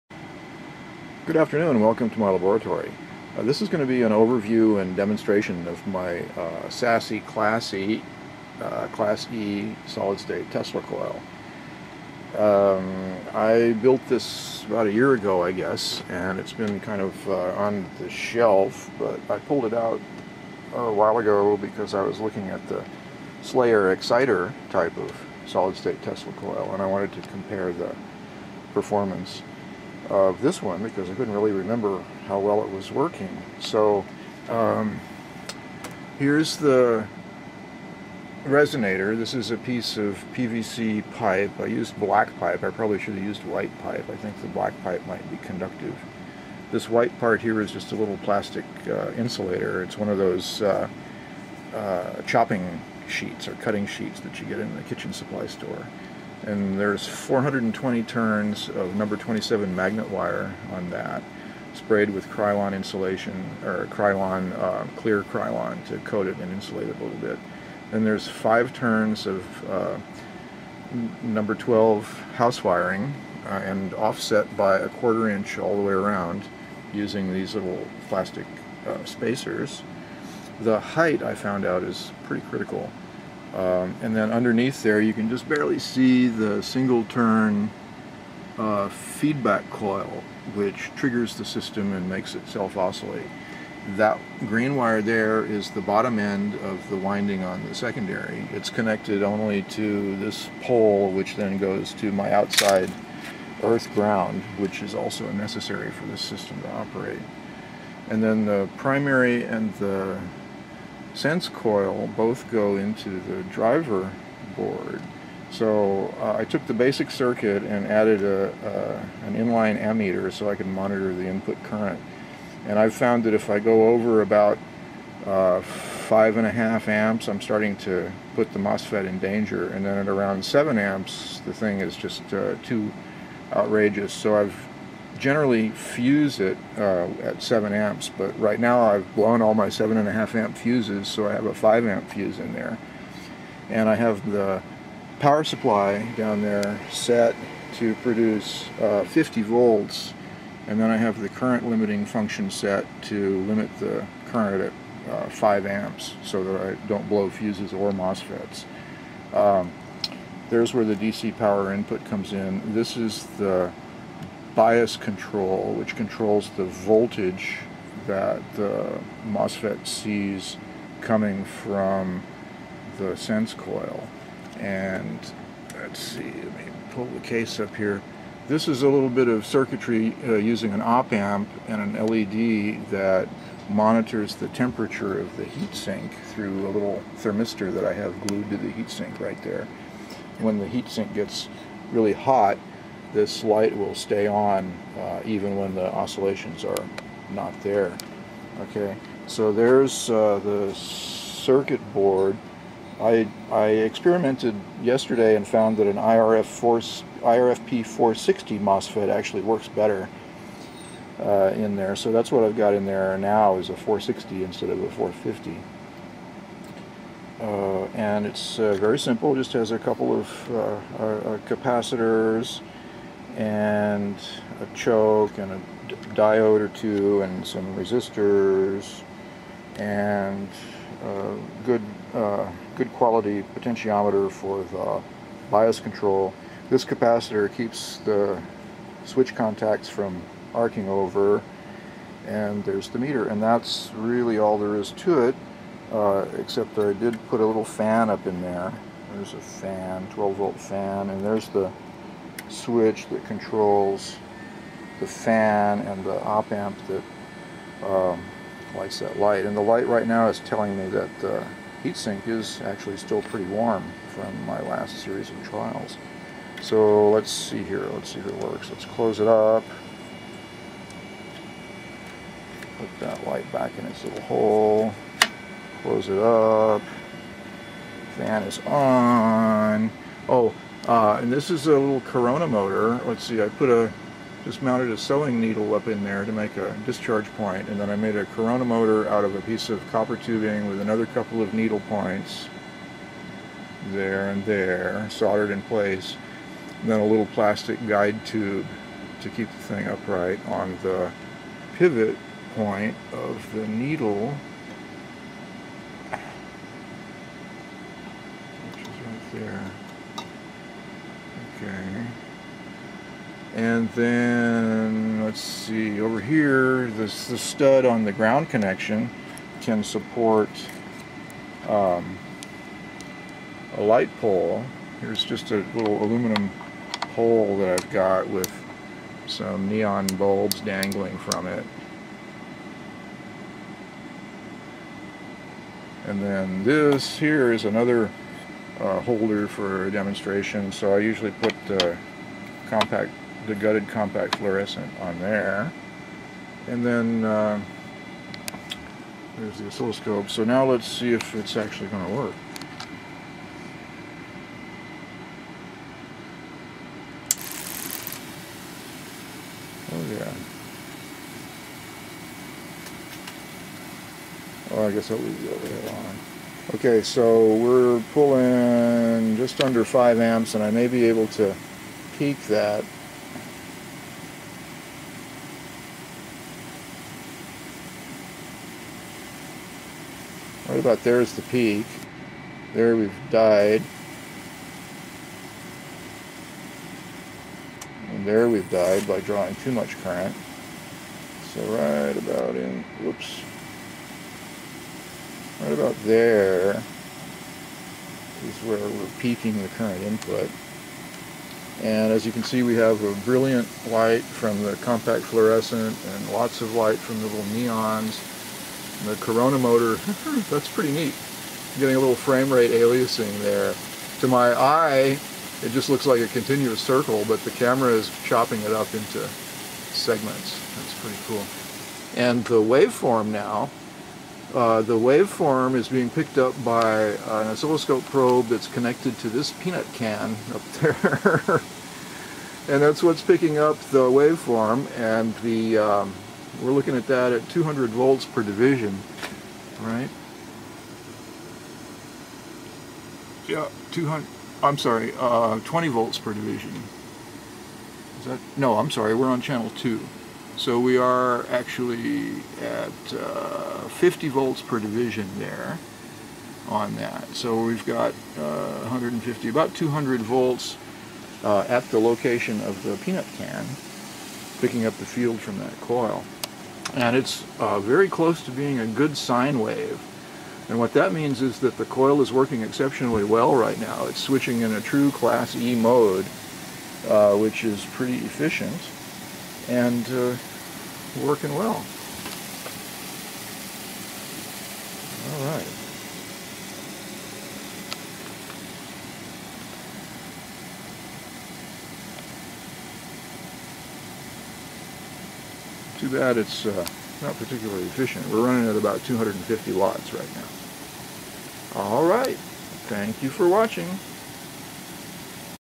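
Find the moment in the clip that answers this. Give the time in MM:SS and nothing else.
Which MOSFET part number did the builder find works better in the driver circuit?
03:26.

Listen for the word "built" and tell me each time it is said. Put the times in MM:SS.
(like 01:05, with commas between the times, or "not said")
00:13.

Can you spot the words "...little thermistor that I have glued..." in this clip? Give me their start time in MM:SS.
03:06.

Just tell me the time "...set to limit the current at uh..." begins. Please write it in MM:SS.
02:32.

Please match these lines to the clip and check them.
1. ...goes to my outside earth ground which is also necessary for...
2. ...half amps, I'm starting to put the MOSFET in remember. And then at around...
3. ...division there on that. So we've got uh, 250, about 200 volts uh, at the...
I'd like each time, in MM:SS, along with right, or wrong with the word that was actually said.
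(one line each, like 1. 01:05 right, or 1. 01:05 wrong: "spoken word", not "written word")
1. 01:41 right
2. 02:06 wrong: "danger", not "remember"
3. 07:34 wrong: "150", not "250".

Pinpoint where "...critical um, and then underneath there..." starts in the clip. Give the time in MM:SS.
01:22.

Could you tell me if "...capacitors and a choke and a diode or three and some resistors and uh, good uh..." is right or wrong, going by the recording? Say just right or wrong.
wrong.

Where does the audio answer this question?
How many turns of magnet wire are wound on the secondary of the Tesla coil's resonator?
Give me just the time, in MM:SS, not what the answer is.
00:57.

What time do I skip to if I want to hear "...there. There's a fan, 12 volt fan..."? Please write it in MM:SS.
04:08.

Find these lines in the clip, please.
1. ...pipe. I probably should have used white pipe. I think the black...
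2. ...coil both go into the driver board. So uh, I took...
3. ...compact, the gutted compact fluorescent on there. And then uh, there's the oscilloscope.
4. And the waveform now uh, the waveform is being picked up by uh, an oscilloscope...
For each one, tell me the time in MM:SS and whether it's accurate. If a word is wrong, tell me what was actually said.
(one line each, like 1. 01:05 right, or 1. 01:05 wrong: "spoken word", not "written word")
1. 00:42 right
2. 01:51 right
3. 05:42 right
4. 07:02 right.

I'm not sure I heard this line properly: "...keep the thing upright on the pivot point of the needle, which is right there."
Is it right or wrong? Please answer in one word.
right.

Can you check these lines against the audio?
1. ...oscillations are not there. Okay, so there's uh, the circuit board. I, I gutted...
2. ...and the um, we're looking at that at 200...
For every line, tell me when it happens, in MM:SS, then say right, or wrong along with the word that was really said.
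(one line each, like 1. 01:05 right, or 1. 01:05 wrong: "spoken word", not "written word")
1. 03:15 wrong: "experimented", not "gutted"
2. 07:14 right.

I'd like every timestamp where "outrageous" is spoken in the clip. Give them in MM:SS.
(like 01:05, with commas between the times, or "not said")
02:13.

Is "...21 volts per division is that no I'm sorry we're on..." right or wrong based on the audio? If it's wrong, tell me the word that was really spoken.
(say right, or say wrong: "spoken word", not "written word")
wrong: "20", not "21".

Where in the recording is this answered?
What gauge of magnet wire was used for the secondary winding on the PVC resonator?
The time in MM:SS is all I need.
00:58.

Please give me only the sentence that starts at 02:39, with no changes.
Um, there's where the DC power input comes in.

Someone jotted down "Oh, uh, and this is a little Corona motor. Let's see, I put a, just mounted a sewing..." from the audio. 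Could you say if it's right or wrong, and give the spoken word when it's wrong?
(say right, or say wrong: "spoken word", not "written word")
right.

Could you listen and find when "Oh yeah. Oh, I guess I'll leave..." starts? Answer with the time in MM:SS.
05:59.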